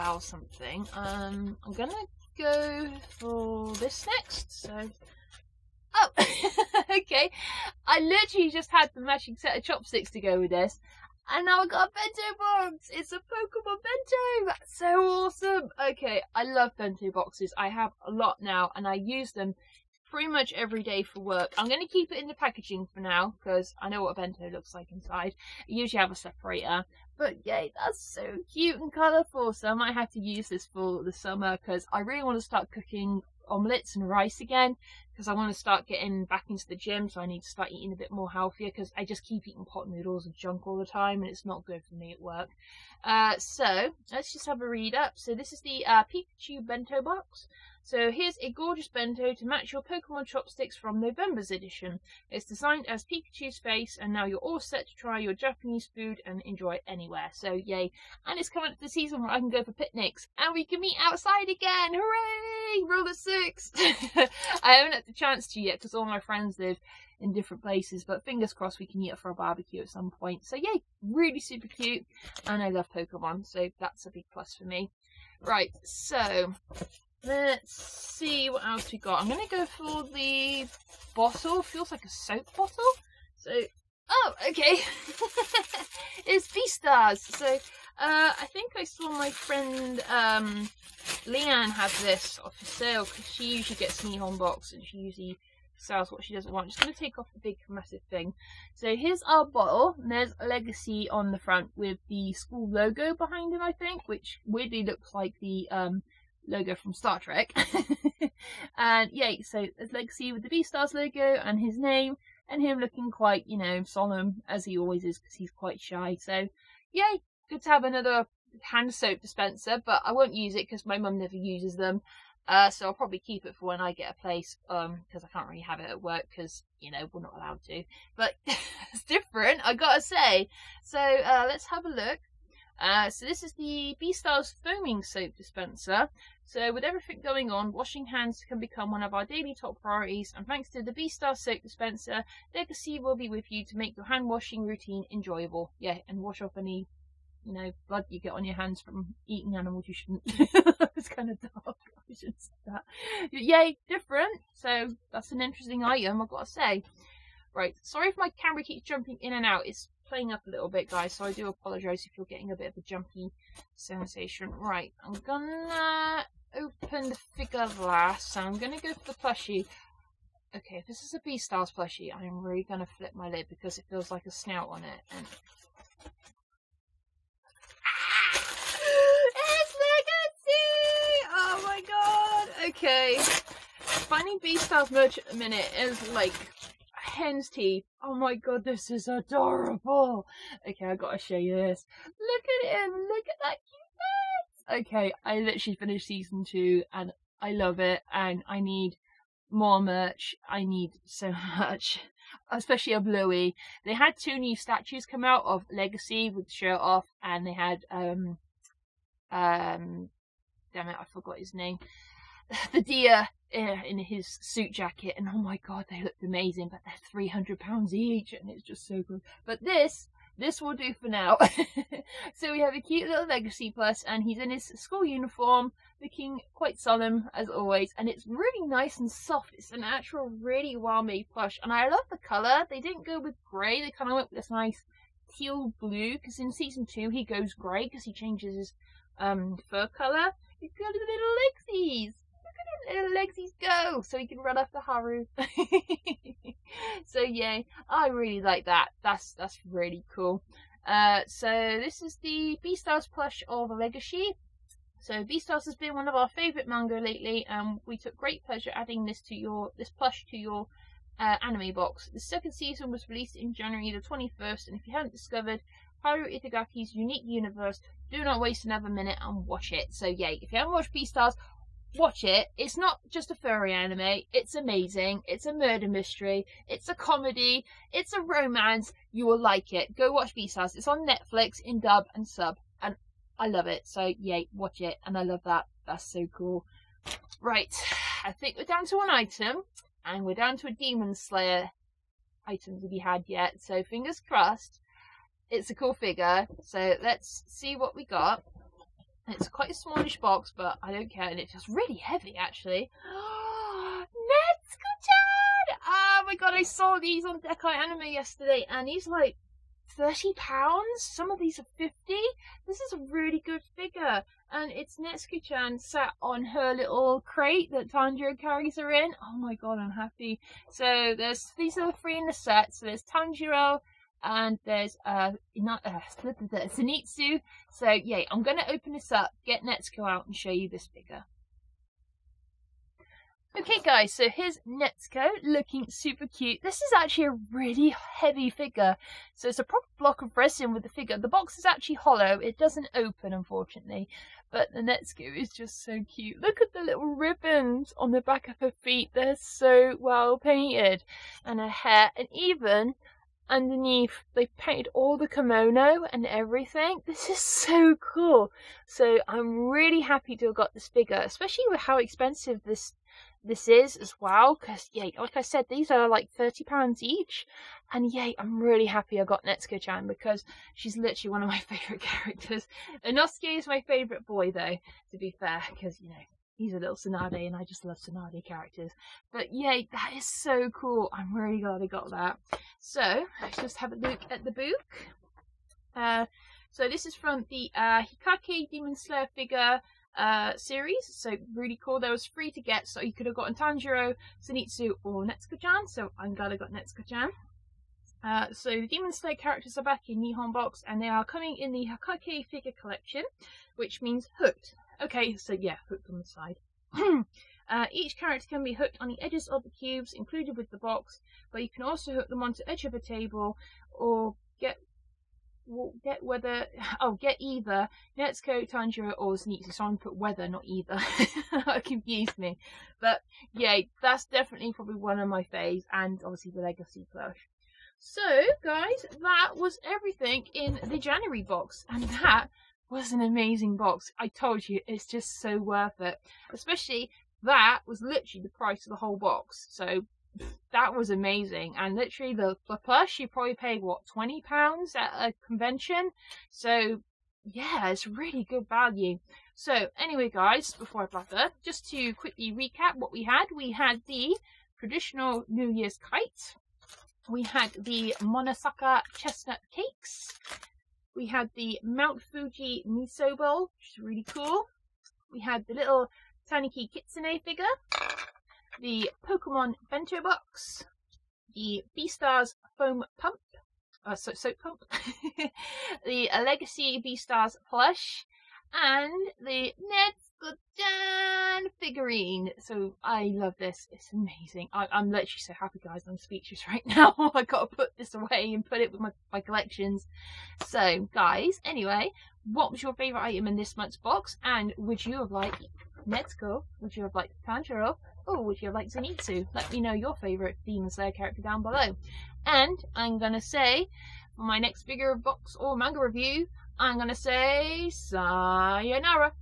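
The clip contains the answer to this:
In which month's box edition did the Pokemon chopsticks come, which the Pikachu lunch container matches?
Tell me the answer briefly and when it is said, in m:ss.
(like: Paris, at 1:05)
November, at 0:50.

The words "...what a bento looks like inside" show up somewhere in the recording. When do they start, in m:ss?
0:24.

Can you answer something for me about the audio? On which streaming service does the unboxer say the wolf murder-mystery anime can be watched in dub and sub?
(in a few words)
Netflix.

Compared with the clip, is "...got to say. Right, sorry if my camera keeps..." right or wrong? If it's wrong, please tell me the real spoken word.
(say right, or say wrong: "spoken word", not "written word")
right.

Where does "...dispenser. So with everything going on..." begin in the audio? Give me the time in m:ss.
2:15.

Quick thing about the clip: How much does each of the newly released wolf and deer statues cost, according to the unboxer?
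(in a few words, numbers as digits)
300 pounds.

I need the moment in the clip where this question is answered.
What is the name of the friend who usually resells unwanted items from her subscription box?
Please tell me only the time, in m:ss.
1:31.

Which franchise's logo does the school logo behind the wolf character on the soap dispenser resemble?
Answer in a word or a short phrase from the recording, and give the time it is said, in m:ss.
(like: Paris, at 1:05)
Star Trek, at 1:46.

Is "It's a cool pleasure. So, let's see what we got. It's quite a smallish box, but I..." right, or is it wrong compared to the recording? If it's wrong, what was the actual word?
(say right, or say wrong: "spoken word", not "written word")
wrong: "figure", not "pleasure".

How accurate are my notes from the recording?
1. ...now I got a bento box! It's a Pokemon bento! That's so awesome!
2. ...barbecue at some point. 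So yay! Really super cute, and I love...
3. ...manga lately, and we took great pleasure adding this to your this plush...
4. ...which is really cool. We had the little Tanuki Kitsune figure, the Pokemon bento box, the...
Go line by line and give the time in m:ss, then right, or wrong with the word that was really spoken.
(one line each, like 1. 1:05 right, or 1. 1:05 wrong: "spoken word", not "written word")
1. 0:11 right
2. 1:09 right
3. 4:16 right
4. 7:43 right.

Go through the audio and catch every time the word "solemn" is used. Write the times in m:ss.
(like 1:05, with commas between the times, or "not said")
1:53, 3:46.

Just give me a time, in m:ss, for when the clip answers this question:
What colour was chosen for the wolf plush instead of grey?
3:55.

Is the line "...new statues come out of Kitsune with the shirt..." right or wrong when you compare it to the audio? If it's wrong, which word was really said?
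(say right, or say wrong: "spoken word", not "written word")
wrong: "Legoshi", not "Kitsune".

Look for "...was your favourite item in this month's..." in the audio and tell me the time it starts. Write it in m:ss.
8:12.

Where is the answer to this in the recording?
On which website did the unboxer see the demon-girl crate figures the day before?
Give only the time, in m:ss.
5:07.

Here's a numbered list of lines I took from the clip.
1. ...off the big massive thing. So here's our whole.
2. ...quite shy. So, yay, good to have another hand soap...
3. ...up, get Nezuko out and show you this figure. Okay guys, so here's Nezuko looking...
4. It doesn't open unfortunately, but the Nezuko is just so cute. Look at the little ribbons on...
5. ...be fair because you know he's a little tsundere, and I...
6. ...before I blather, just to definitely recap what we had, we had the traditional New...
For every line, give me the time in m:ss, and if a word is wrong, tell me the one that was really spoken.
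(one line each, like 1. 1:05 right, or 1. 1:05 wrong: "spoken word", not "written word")
1. 1:37 wrong: "bottle", not "whole"
2. 1:55 right
3. 5:29 right
4. 5:42 right
5. 6:15 right
6. 7:30 wrong: "quickly", not "definitely".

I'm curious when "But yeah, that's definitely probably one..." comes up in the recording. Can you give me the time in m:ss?
7:02.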